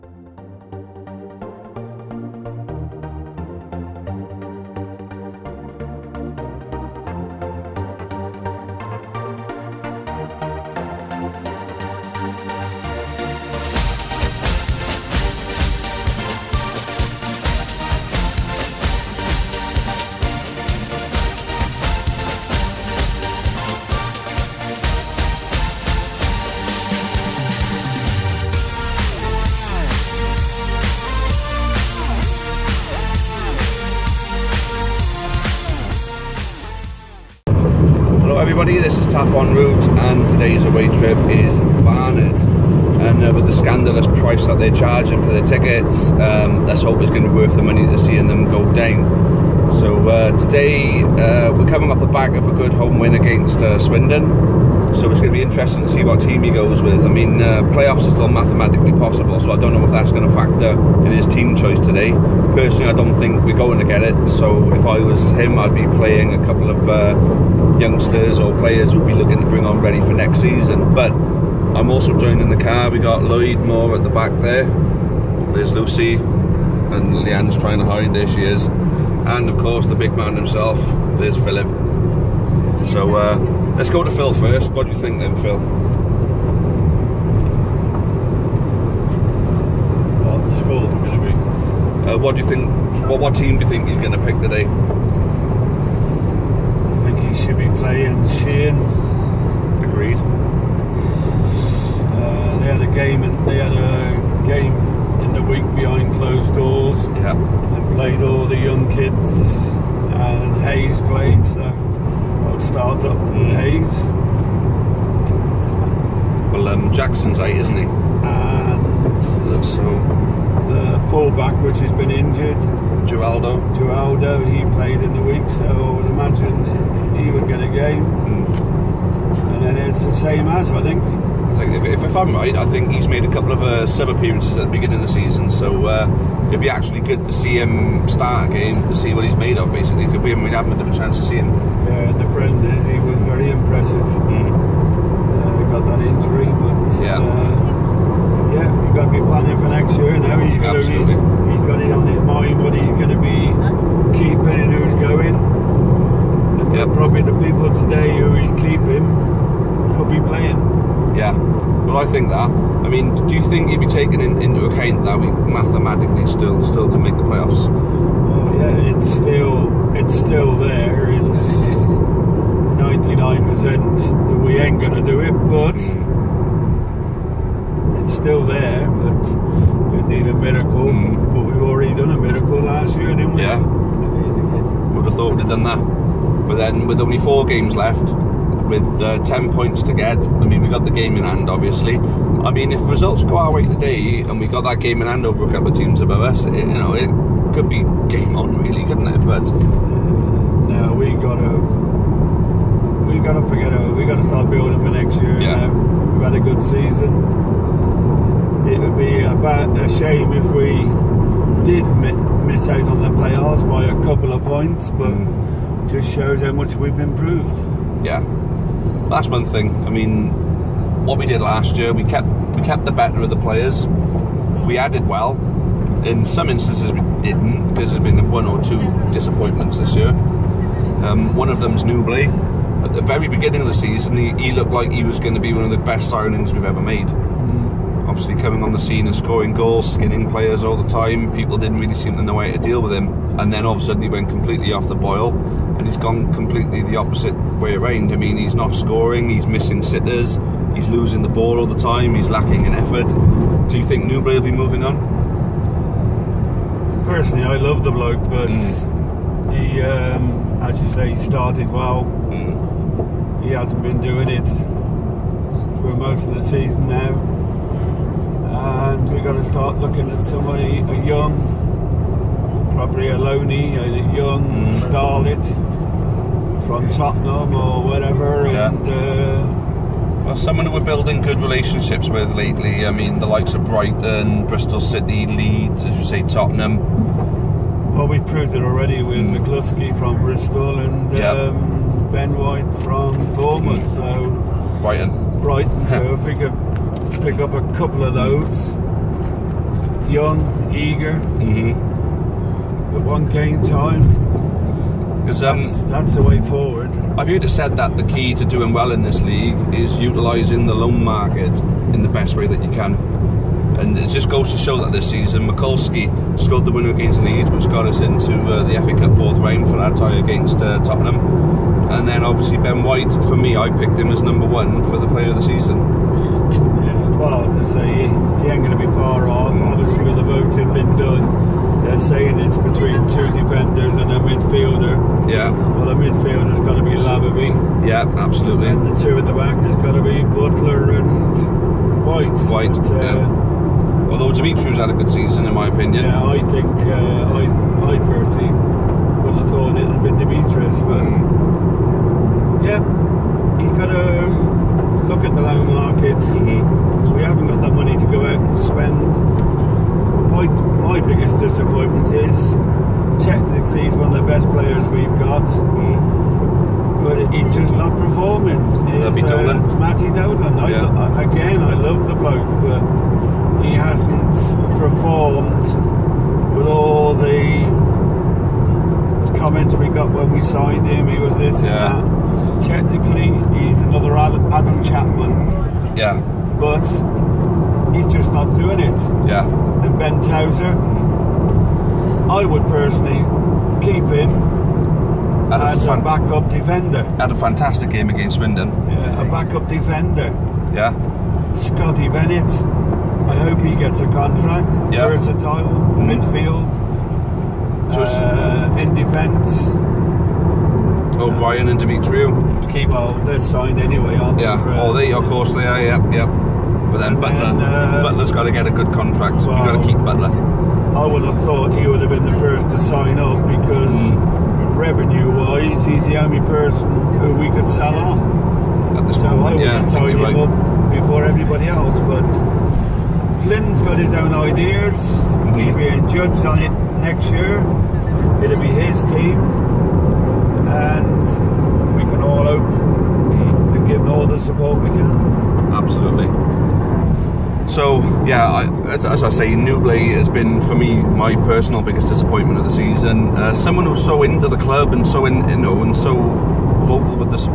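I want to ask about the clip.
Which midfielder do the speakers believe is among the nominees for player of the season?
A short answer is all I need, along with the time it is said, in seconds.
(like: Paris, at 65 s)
Labadie, at 336 s.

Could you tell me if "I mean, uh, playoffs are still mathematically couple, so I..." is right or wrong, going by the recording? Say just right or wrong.
wrong.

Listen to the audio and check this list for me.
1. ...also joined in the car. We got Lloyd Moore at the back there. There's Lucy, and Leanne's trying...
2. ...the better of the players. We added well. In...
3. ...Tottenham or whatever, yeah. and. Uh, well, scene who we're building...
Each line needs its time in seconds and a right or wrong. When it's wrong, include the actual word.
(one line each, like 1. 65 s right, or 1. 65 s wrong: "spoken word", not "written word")
1. 71 s right
2. 222 s right
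3. 276 s wrong: "someone", not "scene".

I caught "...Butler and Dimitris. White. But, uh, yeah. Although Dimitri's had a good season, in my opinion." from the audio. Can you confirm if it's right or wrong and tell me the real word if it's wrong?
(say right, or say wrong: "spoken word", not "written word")
wrong: "White", not "Dimitris".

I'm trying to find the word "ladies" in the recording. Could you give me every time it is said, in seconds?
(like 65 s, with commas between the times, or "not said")
not said.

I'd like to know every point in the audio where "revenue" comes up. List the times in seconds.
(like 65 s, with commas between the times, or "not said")
424 s.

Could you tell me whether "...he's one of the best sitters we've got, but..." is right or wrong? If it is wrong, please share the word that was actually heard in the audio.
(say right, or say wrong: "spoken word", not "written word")
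wrong: "players", not "sitters".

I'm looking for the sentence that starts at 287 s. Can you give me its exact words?
Well, we have proved it already with mm.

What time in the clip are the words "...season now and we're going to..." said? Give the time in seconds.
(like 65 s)
266 s.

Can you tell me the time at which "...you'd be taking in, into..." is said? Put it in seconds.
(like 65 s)
163 s.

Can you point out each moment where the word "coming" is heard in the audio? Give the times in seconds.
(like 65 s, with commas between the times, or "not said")
51 s, 238 s.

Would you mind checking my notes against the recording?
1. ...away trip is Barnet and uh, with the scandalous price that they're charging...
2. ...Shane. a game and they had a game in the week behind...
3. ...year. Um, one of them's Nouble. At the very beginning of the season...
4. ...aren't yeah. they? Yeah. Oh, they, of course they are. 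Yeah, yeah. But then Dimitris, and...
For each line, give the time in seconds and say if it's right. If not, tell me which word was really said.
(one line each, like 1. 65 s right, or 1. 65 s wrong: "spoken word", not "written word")
1. 40 s right
2. 98 s right
3. 229 s right
4. 414 s wrong: "Butler", not "Dimitris".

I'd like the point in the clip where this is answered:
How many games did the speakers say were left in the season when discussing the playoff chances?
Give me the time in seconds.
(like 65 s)
187 s.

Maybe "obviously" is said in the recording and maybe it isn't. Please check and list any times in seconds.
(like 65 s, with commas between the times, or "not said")
191 s, 238 s, 322 s, 329 s.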